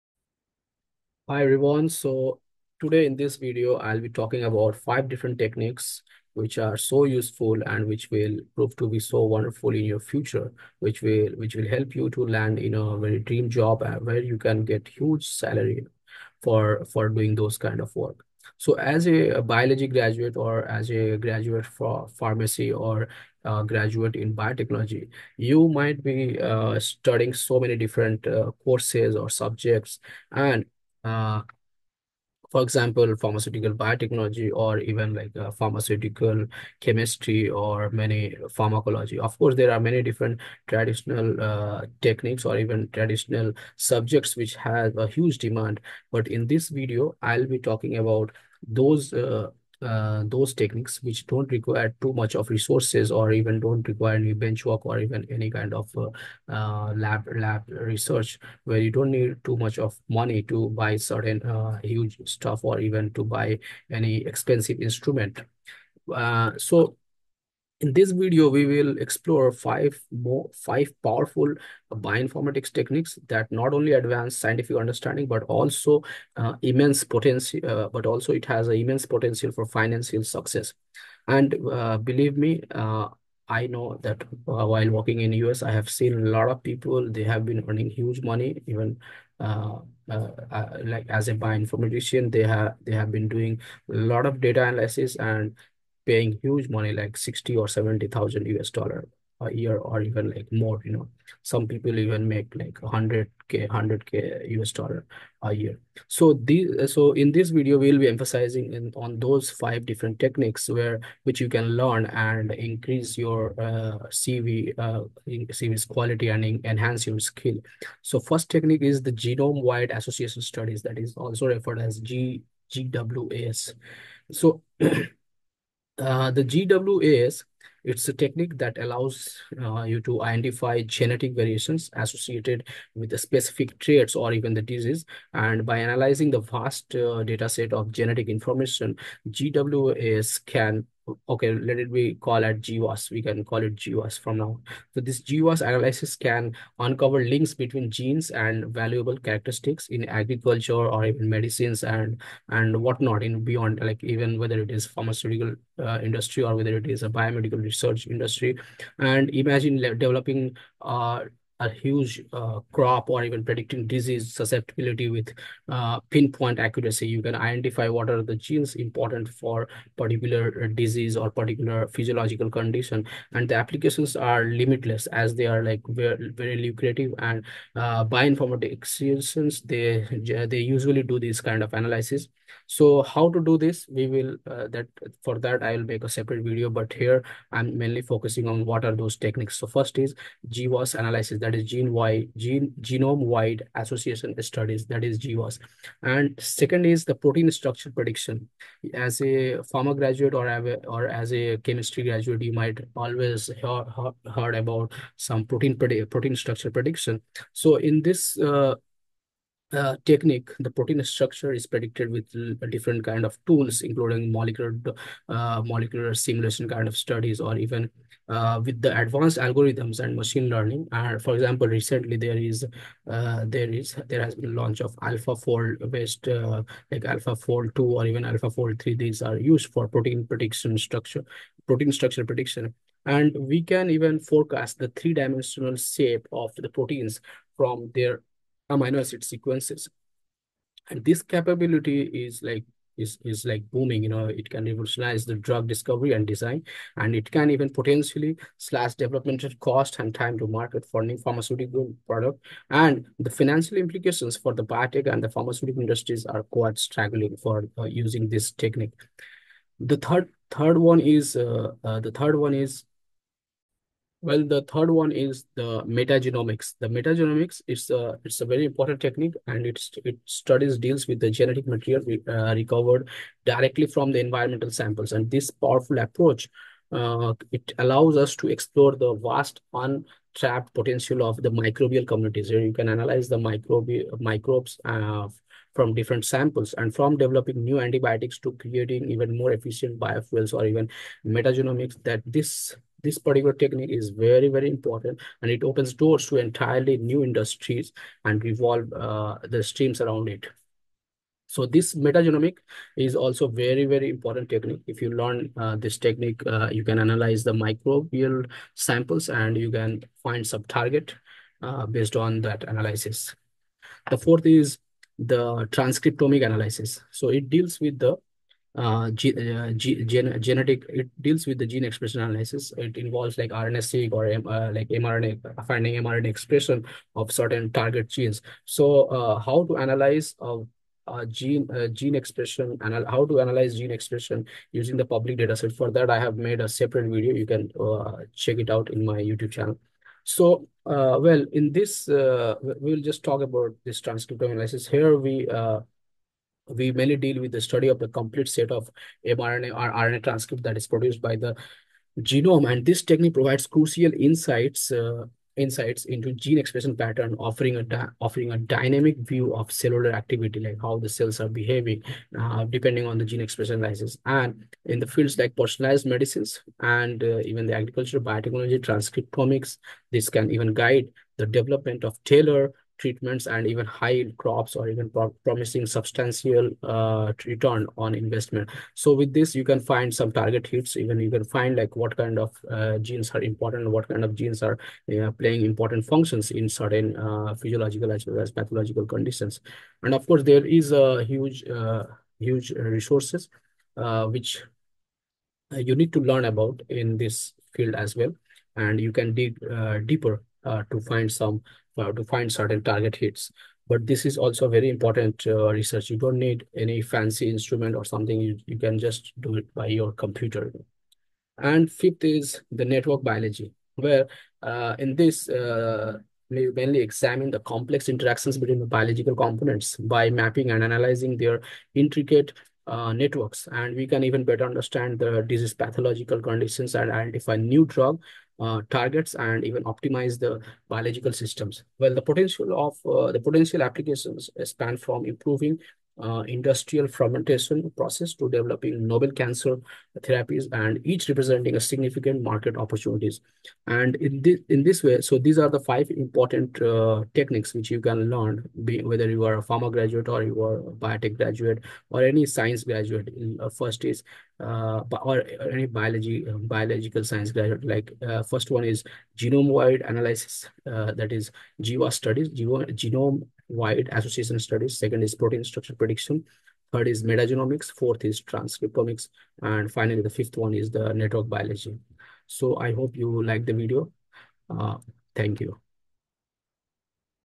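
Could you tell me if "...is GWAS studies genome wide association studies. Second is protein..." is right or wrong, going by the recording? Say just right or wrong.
right.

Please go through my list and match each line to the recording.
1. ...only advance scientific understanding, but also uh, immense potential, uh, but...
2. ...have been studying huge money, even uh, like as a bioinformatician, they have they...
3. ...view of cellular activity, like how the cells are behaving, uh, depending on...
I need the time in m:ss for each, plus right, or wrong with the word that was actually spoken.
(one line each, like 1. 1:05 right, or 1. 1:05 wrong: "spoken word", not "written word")
1. 1:13 right
2. 1:27 wrong: "earning", not "studying"
3. 5:59 right.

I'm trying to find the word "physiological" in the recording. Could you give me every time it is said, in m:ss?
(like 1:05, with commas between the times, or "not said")
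2:51, 6:27.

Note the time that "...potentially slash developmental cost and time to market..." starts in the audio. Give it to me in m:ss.
4:07.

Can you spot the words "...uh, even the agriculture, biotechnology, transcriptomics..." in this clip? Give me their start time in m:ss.
6:07.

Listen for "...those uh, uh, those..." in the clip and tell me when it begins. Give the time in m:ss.
0:48.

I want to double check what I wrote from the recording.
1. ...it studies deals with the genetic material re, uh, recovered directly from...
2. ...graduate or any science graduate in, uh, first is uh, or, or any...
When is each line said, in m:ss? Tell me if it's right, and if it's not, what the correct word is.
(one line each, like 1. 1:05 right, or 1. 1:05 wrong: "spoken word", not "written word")
1. 4:30 right
2. 7:31 right.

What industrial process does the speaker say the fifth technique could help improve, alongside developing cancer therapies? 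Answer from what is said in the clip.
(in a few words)
Industrial fermentation.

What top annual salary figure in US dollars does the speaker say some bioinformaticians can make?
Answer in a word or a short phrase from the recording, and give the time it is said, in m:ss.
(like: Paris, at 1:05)
100k, at 1:43.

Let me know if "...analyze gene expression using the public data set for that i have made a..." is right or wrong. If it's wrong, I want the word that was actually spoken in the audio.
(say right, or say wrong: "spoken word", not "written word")
right.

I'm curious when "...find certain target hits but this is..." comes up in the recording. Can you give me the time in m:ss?
6:42.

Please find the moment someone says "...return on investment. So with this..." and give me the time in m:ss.
6:17.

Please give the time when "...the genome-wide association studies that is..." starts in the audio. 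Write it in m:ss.
1:59.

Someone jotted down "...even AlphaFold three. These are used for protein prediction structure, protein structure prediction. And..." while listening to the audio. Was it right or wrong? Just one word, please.
right.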